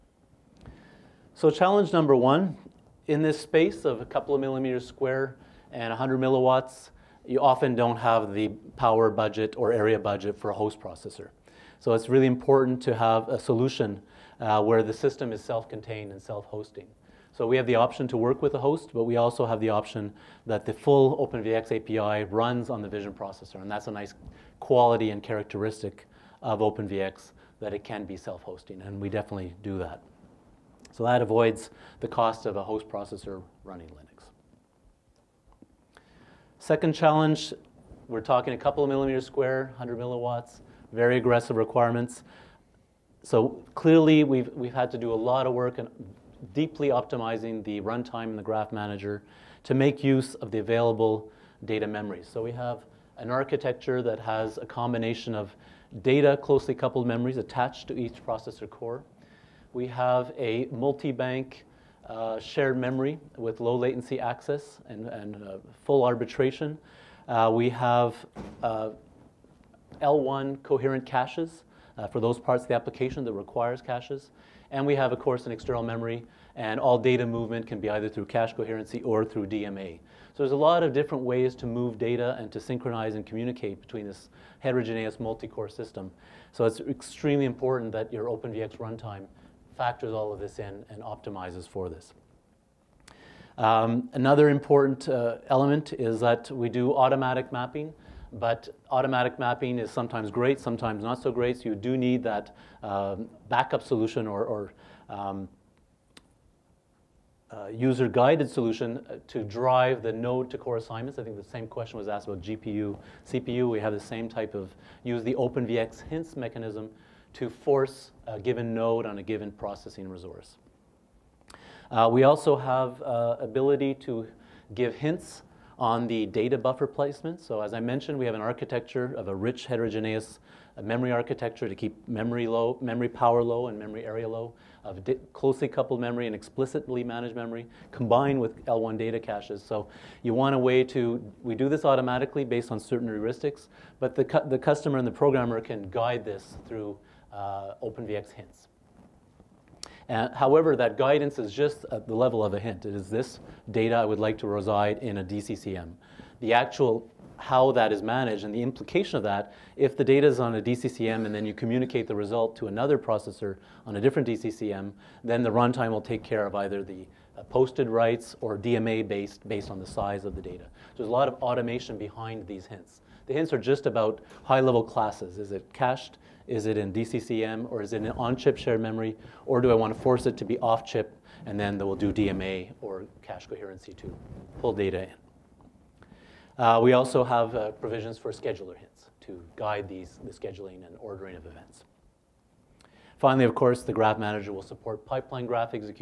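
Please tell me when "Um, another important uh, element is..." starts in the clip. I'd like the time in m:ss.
1:33.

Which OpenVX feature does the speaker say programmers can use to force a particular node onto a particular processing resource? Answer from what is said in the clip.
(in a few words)
Hints mechanism.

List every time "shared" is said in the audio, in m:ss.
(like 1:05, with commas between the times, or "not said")
1:02, 2:58.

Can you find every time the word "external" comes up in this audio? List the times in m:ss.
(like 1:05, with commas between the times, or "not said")
1:15.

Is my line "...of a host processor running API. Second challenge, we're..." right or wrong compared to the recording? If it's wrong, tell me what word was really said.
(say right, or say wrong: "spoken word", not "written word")
wrong: "Linux", not "API".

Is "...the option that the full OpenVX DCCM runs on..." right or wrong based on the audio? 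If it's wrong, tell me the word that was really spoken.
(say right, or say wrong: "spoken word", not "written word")
wrong: "API", not "DCCM".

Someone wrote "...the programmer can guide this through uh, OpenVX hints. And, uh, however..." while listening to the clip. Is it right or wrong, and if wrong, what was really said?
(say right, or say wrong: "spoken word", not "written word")
right.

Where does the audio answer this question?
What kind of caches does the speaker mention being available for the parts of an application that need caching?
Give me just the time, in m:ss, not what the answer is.
1:10.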